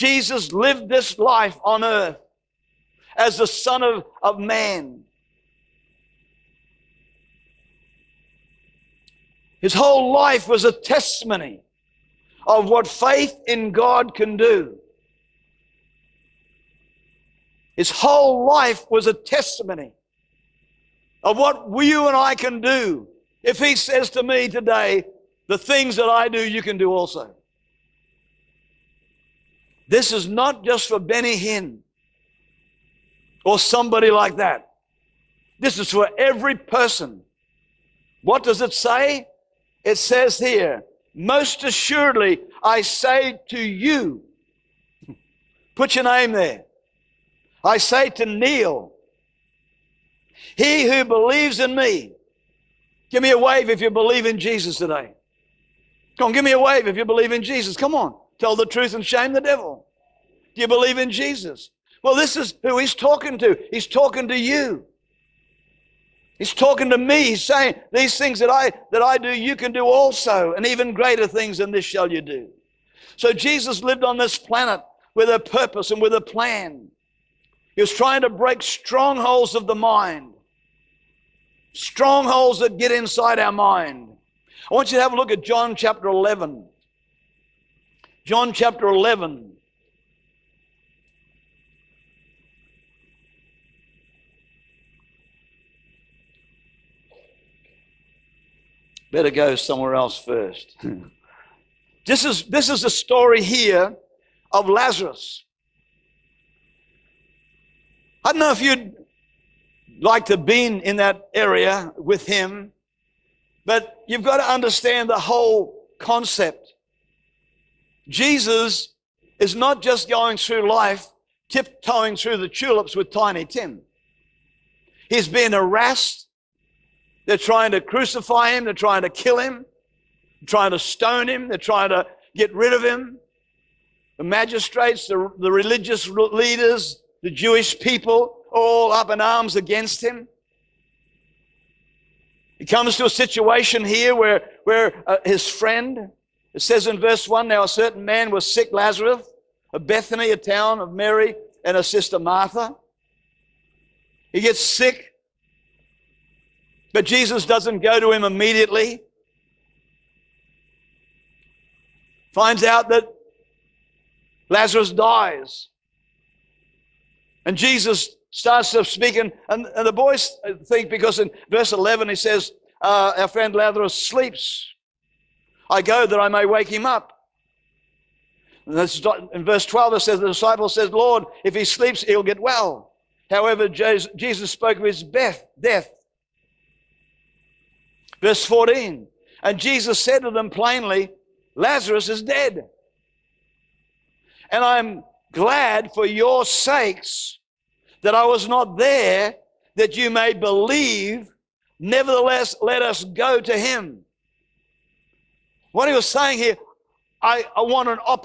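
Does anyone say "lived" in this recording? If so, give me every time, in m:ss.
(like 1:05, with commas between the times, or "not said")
0:00, 1:13.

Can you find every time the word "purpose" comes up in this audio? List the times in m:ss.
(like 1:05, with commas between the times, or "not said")
1:15.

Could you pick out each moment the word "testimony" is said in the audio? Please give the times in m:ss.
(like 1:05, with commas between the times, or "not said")
0:10, 0:19.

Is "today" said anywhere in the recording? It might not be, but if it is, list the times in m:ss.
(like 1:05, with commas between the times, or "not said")
0:24, 0:54.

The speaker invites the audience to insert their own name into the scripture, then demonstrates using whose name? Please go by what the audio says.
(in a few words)
Neil.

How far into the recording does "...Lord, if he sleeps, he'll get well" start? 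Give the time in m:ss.
3:00.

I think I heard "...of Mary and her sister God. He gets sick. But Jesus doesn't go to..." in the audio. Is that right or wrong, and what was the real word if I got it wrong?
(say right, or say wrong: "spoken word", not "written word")
wrong: "Martha", not "God".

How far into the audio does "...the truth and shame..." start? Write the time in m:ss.
0:58.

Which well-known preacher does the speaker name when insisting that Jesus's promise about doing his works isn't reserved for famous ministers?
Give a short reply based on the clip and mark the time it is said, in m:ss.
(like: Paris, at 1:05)
Benny Hinn, at 0:30.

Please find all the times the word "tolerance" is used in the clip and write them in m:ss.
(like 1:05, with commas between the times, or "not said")
not said.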